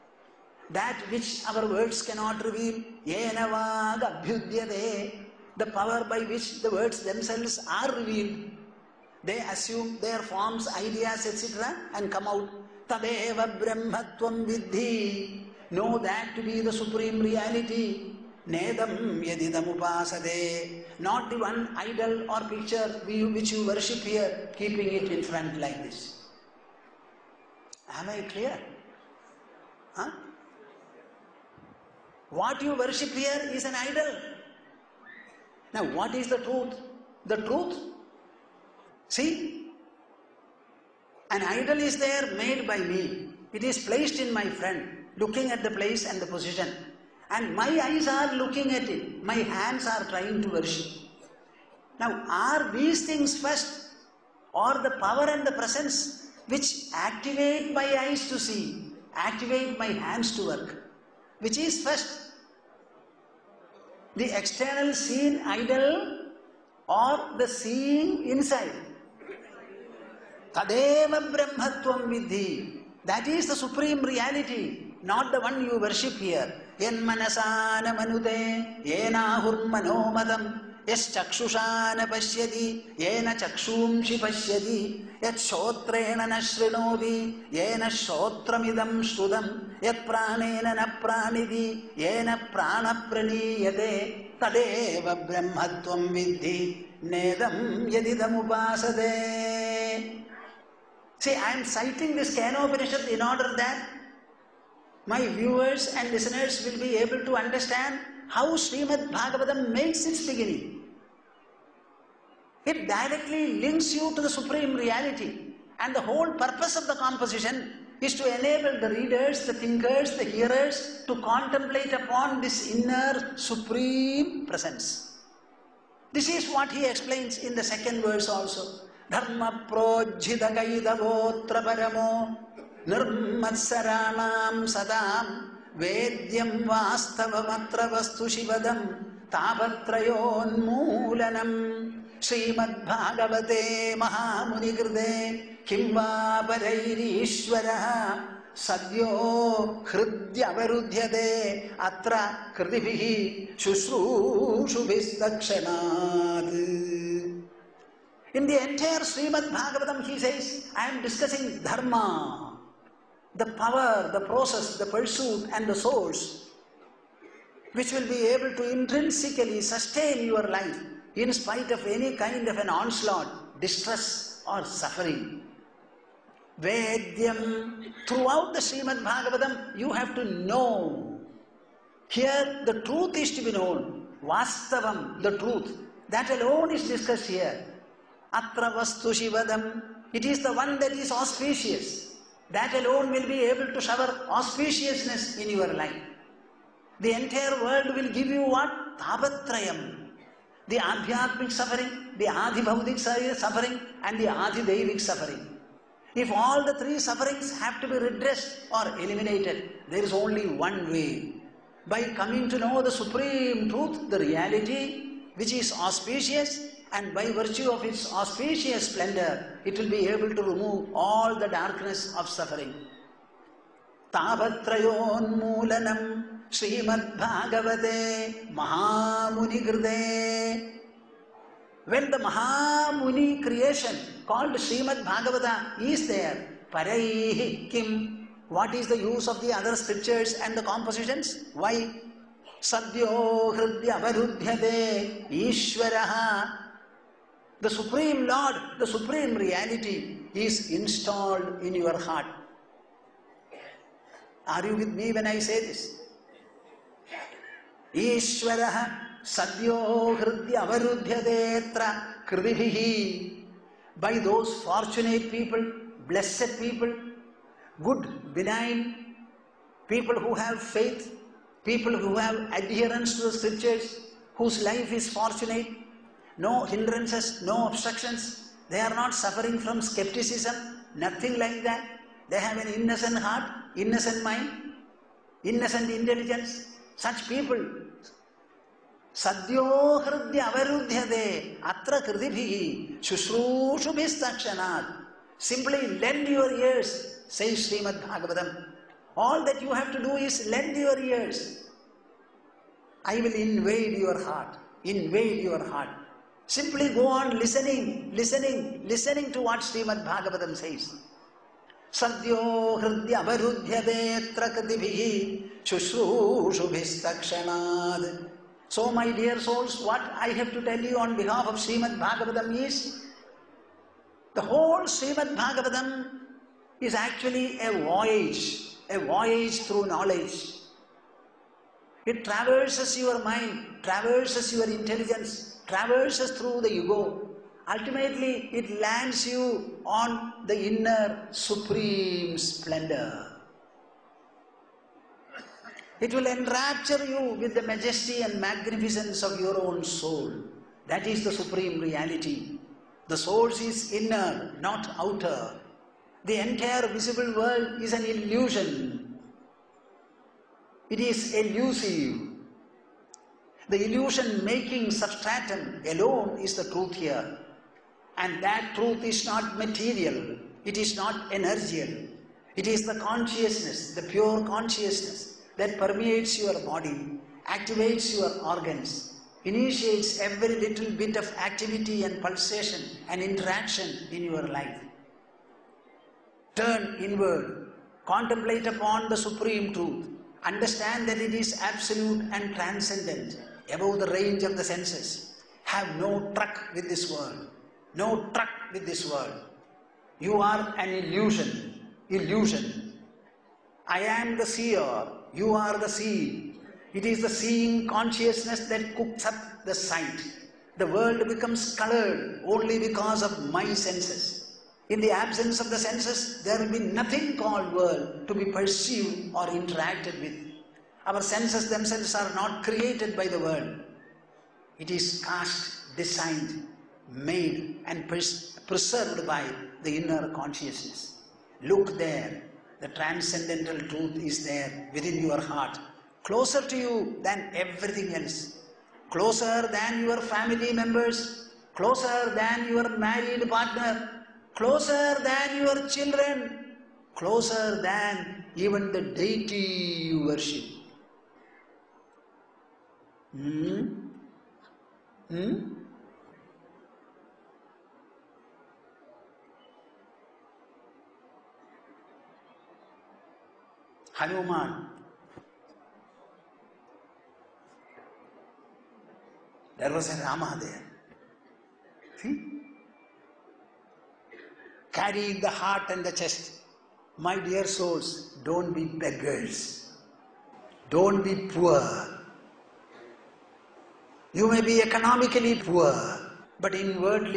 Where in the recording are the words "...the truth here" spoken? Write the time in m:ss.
6:06.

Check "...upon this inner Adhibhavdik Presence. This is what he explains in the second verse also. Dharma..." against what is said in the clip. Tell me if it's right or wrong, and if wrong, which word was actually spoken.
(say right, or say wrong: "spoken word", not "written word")
wrong: "Supreme", not "Adhibhavdik".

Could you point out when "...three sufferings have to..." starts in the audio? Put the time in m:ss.
3:26.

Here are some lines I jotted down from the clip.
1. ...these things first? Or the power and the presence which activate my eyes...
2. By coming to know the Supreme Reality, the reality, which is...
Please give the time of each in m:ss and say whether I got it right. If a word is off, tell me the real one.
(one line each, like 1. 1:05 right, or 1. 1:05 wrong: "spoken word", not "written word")
1. 0:52 right
2. 3:31 wrong: "Truth", not "Reality".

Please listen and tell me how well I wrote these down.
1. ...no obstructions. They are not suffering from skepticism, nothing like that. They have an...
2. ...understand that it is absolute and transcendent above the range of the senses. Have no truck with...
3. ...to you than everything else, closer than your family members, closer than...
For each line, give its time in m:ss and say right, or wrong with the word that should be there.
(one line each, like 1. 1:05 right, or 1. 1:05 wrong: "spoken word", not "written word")
1. 4:37 right
2. 6:30 right
3. 7:16 right.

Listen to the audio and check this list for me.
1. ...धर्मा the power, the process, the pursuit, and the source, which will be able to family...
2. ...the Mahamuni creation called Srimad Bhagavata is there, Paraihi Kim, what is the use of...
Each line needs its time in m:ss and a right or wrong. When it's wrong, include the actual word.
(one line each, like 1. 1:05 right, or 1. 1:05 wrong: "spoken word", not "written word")
1. 2:41 wrong: "intrinsically", not "family"
2. 3:52 right.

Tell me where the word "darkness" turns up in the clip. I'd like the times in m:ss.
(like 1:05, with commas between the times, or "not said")
3:41.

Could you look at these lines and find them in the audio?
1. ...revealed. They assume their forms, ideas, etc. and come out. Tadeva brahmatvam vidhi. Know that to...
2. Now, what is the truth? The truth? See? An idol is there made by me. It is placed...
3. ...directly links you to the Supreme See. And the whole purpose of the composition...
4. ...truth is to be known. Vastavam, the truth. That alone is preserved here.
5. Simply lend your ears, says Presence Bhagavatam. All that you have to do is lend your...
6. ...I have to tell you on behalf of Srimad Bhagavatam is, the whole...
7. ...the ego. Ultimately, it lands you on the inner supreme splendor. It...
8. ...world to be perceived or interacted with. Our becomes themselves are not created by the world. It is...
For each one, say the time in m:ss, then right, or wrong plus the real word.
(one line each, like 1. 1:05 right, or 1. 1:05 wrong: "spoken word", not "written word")
1. 0:07 right
2. 0:35 right
3. 1:52 wrong: "Reality", not "See"
4. 3:02 wrong: "discussed", not "preserved"
5. 4:55 wrong: "Srimad", not "Presence"
6. 5:20 right
7. 5:36 right
8. 6:57 wrong: "senses", not "becomes".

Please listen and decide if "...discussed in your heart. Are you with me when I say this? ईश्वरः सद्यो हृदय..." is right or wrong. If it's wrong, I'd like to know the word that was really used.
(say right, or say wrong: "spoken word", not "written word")
wrong: "installed", not "discussed".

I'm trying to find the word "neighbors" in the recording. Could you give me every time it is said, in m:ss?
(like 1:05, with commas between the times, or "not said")
not said.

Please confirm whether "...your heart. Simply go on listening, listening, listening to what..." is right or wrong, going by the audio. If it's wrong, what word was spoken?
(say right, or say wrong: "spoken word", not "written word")
right.